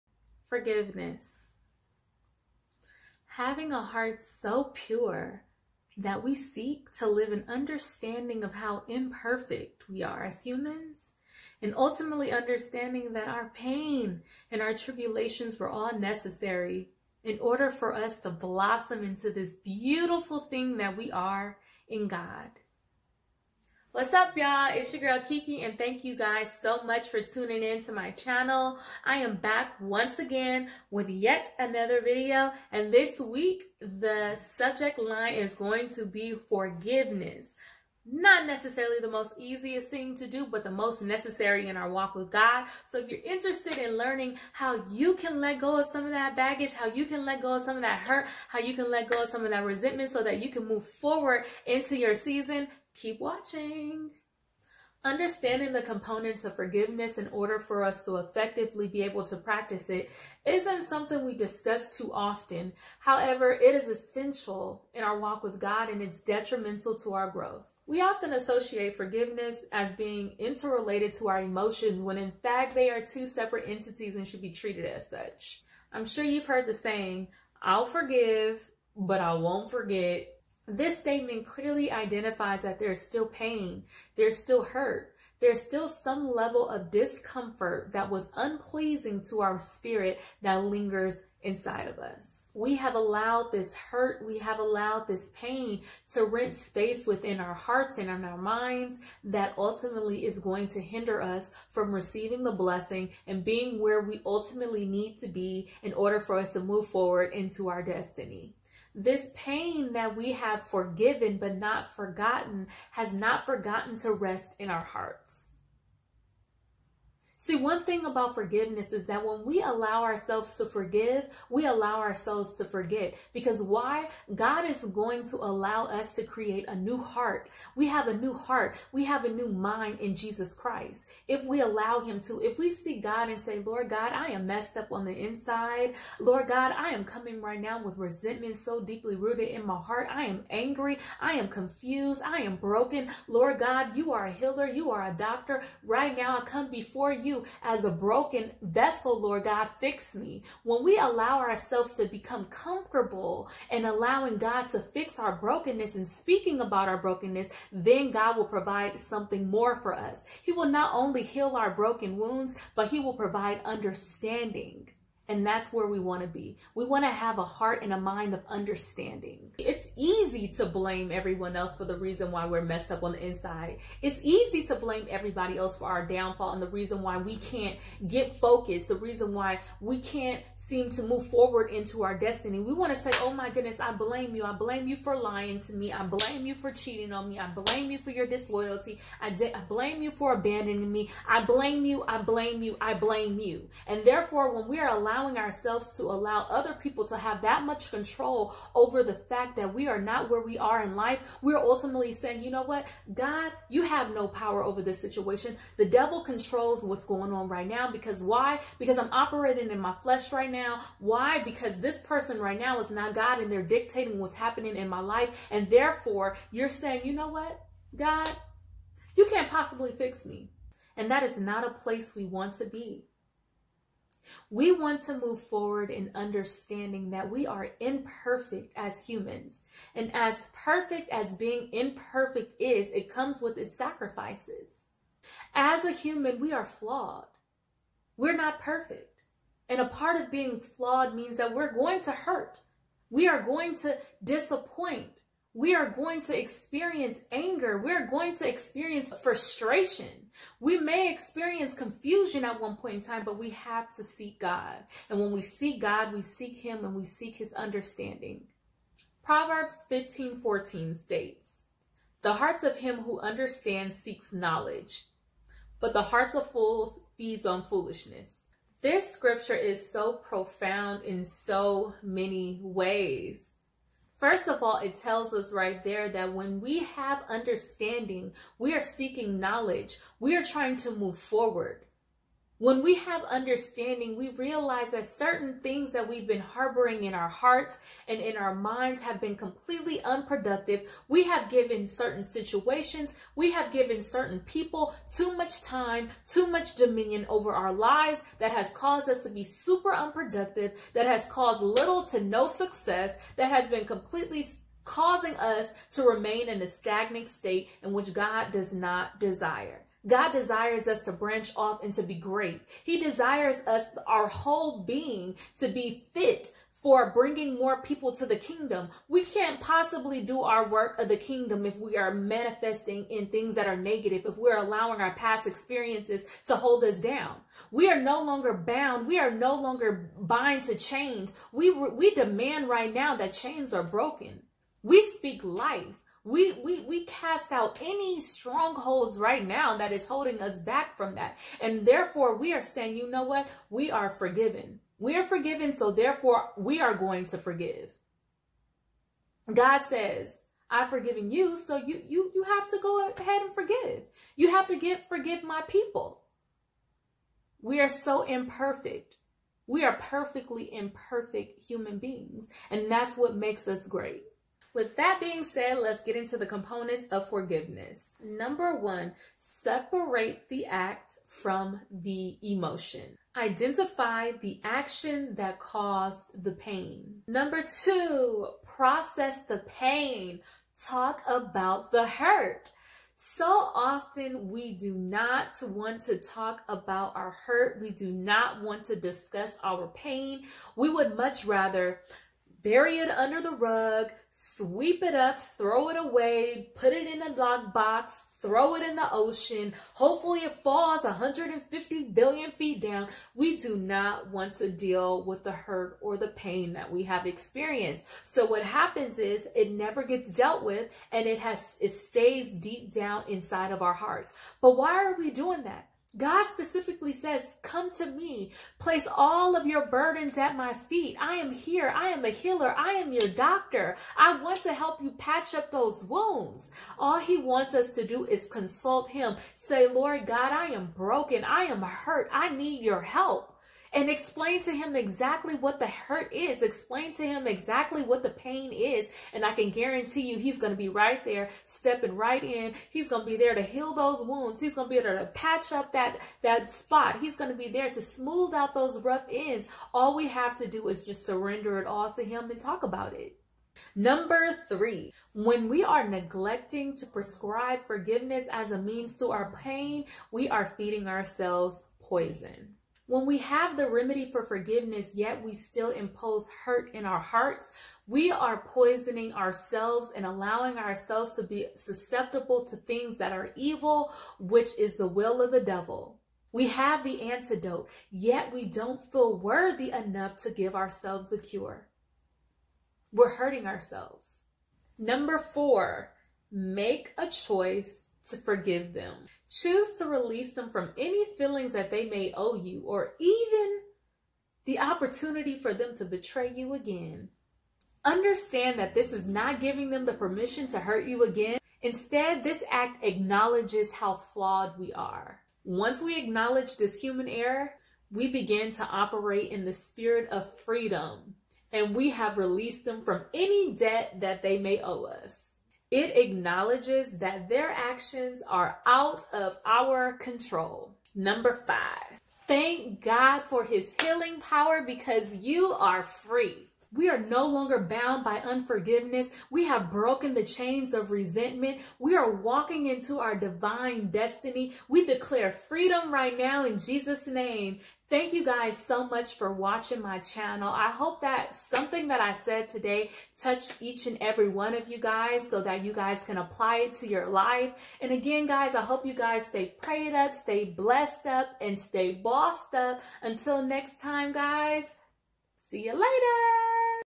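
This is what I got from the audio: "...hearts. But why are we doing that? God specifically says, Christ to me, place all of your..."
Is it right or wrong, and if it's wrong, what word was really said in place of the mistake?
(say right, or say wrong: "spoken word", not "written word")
wrong: "Come", not "Christ".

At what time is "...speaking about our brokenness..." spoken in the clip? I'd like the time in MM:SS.
02:36.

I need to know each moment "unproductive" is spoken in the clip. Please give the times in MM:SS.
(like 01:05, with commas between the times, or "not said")
04:50, 04:59.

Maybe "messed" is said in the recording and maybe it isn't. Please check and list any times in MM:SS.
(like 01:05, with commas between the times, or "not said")
02:14, 02:52.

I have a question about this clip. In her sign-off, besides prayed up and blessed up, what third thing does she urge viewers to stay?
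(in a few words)
bossed up.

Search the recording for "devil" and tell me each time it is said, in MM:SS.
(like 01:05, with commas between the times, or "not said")
03:25, 07:55.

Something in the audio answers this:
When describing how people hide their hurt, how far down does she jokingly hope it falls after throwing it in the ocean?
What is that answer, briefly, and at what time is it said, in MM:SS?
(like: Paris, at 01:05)
150 billion feet, at 06:41.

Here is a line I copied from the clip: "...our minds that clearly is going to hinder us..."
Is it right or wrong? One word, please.
wrong.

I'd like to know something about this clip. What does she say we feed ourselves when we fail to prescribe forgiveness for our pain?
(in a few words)
poison.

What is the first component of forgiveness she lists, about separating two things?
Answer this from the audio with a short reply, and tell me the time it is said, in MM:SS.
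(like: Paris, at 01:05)
separate the act from the emotion, at 06:09.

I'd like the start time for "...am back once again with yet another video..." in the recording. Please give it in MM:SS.
00:29.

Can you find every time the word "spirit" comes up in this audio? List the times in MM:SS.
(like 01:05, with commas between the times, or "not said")
01:29, 08:29.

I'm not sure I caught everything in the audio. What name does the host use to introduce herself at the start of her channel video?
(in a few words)
Kiki.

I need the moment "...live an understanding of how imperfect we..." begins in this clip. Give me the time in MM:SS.
00:07.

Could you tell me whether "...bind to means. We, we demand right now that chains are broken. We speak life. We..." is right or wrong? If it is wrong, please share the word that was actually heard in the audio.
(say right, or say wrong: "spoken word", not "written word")
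wrong: "chains", not "means".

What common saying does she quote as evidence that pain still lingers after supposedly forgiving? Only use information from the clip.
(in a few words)
I'll forgive, but I won't forget.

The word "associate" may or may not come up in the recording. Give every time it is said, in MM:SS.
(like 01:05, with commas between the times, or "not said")
01:08.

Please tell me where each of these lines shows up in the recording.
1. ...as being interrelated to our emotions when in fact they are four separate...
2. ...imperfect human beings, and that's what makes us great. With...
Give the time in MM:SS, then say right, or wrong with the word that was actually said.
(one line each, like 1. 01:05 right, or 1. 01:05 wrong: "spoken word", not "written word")
1. 01:09 wrong: "two", not "four"
2. 06:00 right.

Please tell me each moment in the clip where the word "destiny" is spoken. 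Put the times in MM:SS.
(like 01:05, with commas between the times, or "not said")
01:47, 03:02, 08:54.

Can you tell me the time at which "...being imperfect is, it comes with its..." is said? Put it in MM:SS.
03:51.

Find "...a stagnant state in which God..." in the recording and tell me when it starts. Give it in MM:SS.
05:06.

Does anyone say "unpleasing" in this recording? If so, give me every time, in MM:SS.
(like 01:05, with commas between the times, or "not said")
01:28.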